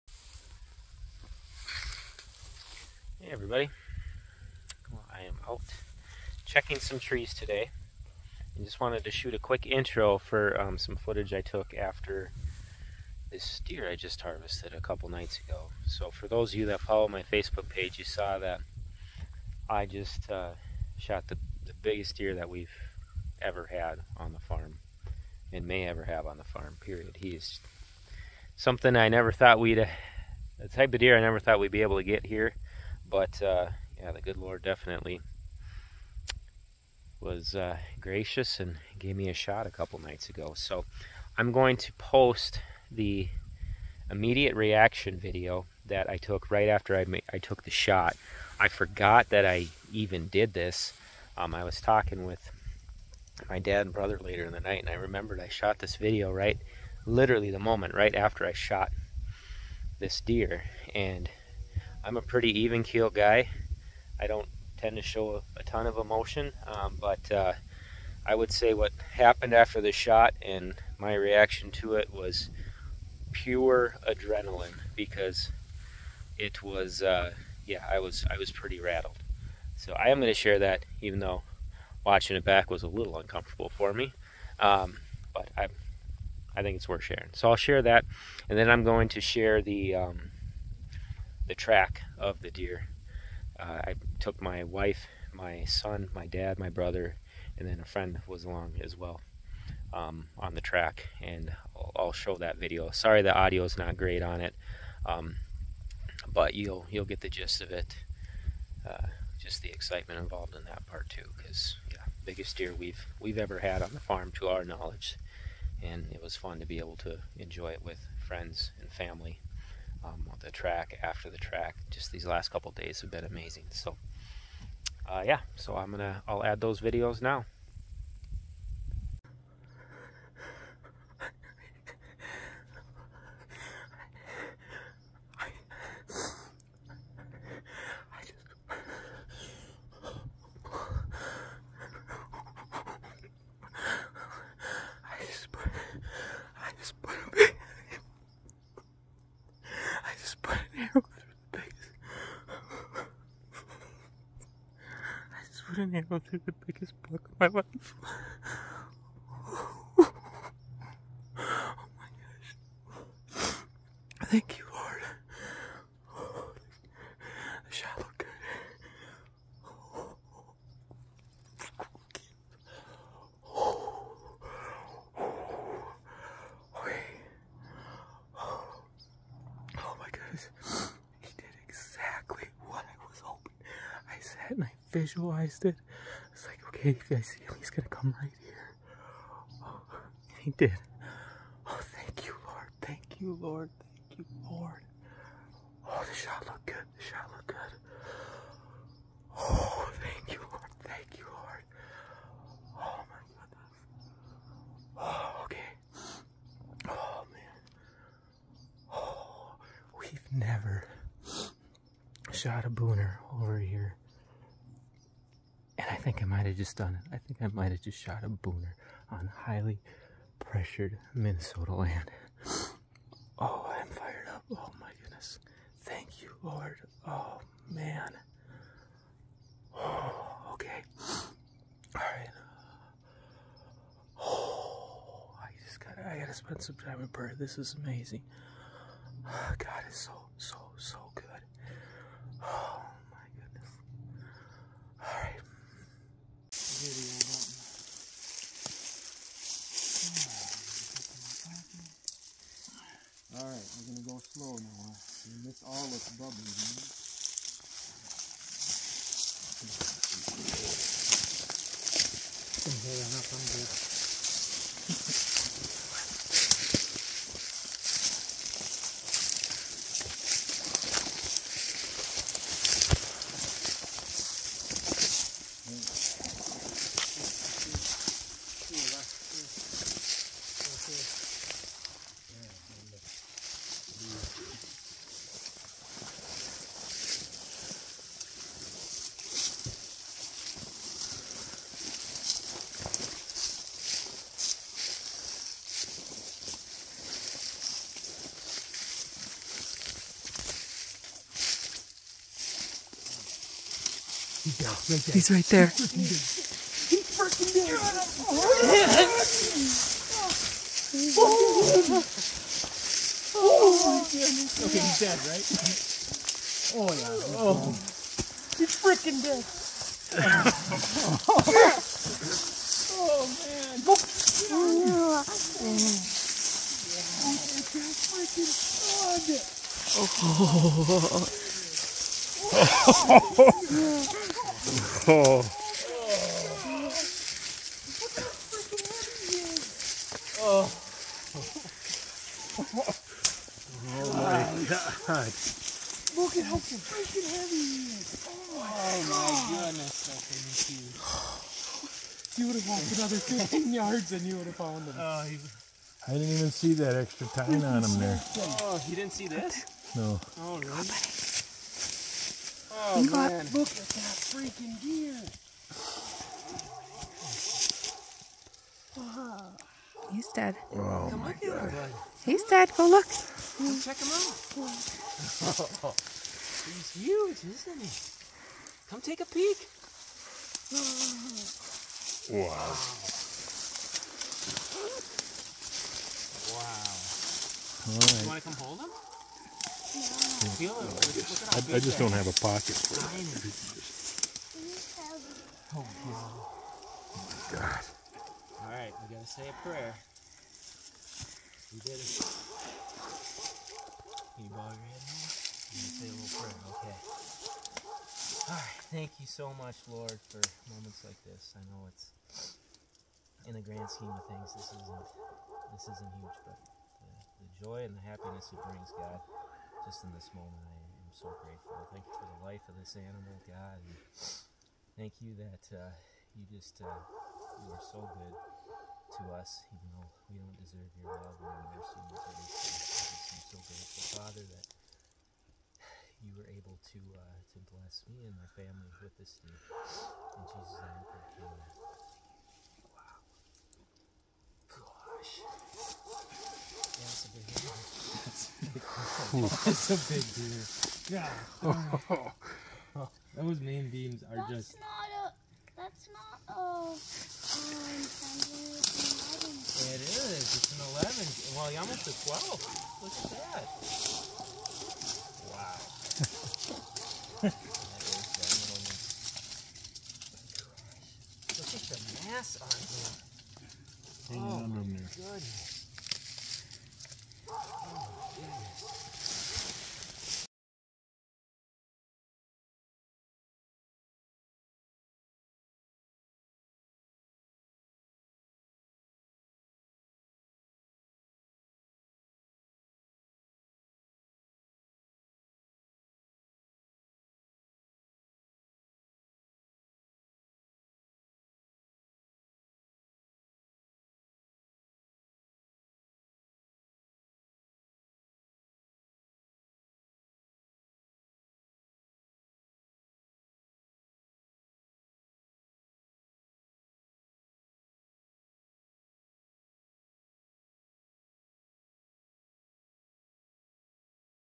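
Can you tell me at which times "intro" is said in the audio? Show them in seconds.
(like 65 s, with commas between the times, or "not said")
9 s.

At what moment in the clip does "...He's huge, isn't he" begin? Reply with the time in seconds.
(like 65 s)
376 s.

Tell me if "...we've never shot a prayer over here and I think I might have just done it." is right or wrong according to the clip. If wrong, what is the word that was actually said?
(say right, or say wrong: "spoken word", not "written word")
wrong: "booner", not "prayer".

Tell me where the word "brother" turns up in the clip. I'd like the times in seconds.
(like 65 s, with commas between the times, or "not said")
53 s, 96 s.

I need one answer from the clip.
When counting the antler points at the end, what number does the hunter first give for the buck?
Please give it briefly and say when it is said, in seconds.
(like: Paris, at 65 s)
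11, at 460 s.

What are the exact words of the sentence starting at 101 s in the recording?
And I'll, I'll, show that video.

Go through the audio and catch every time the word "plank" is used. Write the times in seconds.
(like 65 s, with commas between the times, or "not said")
not said.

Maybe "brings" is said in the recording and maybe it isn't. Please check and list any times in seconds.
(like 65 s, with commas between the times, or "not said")
418 s.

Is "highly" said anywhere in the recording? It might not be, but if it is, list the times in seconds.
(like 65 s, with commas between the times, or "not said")
219 s.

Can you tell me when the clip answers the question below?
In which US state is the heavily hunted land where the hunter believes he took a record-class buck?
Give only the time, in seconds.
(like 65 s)
221 s.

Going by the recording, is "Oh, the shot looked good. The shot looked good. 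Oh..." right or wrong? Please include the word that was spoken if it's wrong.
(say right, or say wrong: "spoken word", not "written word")
right.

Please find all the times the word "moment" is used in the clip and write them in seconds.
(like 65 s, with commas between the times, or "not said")
57 s, 410 s, 420 s.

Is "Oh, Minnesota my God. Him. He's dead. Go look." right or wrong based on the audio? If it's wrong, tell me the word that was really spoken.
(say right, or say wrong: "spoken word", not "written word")
wrong: "Come", not "Minnesota".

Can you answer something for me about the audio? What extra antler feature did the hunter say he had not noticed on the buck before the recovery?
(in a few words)
extra tine.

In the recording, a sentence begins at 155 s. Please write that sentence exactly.
couldn't handle through the biggest block of my life.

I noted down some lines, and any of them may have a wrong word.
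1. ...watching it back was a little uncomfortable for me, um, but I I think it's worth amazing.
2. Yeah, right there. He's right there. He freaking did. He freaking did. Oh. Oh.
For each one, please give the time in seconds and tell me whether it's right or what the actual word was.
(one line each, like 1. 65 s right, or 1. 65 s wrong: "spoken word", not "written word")
1. 82 s wrong: "sharing", not "amazing"
2. 304 s right.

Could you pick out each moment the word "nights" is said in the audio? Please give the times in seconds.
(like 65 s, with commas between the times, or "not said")
15 s, 39 s, 54 s.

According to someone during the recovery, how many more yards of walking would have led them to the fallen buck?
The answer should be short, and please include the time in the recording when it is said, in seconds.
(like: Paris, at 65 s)
15, at 353 s.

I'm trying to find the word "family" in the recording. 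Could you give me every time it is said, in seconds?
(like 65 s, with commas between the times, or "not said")
118 s, 438 s.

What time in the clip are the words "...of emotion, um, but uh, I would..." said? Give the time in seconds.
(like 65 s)
65 s.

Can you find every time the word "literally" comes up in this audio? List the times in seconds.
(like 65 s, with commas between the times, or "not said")
57 s.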